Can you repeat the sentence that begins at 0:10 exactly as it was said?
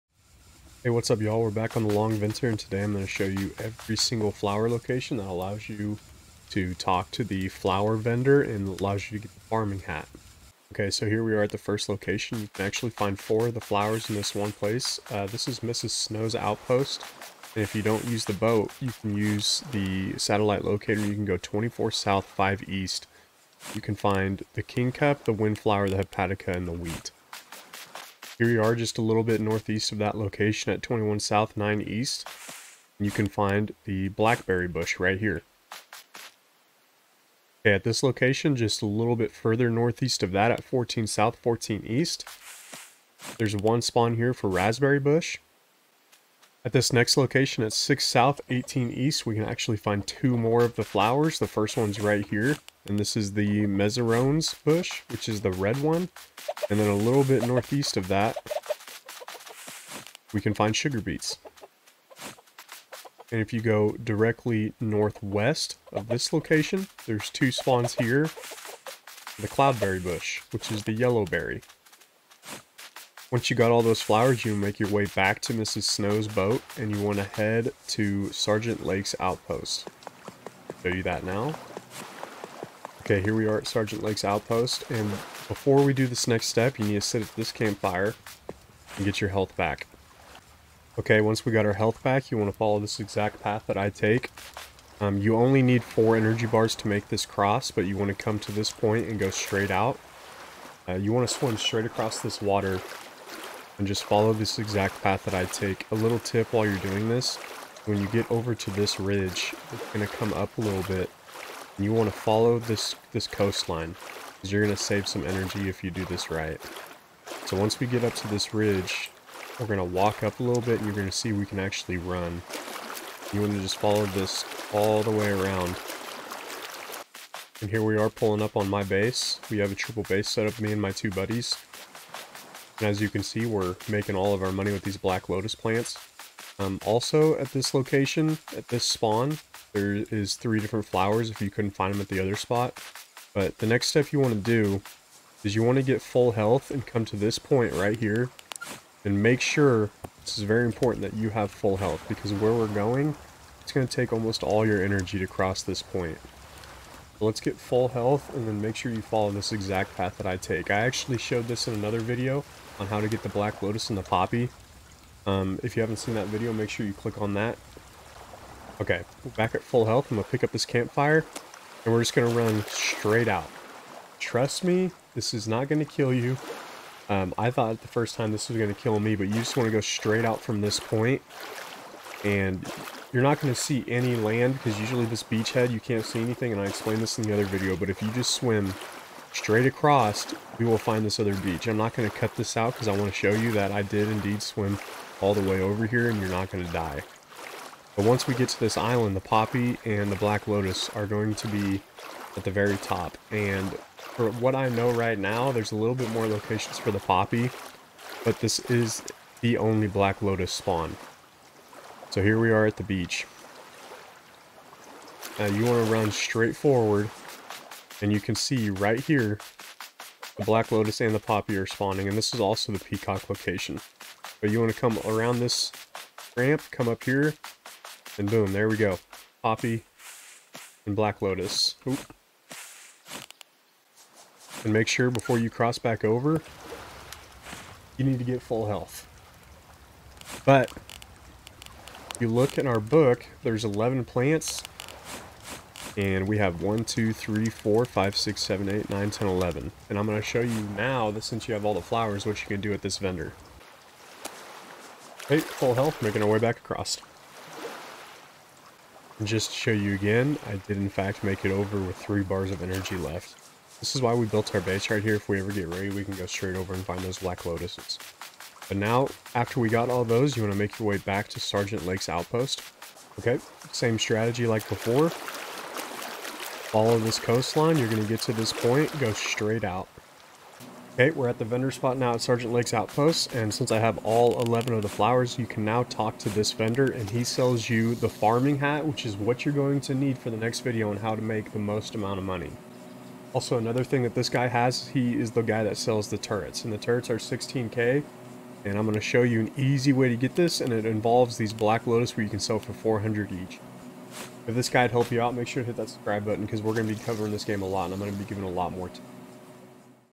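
Okay, so here we are at the first location.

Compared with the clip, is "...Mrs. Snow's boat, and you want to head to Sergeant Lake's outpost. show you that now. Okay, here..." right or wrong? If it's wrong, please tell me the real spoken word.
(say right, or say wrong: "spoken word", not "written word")
right.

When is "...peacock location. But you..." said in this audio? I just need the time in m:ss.
3:42.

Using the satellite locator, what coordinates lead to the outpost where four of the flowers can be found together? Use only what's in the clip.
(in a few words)
24 south, 5 east.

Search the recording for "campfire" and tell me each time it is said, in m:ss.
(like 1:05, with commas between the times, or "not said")
1:27, 2:50.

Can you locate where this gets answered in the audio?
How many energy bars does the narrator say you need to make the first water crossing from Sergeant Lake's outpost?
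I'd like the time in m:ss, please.
1:35.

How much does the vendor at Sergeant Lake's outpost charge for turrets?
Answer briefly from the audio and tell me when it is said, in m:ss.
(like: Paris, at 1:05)
16k, at 4:57.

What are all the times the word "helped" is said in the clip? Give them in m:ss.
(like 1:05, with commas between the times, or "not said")
5:04.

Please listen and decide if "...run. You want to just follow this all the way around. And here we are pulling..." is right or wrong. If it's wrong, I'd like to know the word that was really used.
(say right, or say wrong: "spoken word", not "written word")
right.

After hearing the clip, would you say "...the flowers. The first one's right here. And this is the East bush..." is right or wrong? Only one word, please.
wrong.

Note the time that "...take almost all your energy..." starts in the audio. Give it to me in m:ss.
2:33.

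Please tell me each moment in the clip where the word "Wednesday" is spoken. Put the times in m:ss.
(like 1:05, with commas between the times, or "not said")
not said.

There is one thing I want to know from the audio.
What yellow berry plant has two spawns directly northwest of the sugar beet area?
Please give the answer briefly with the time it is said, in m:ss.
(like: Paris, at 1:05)
cloudberry bush, at 1:09.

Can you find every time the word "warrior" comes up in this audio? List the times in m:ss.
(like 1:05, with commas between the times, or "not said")
not said.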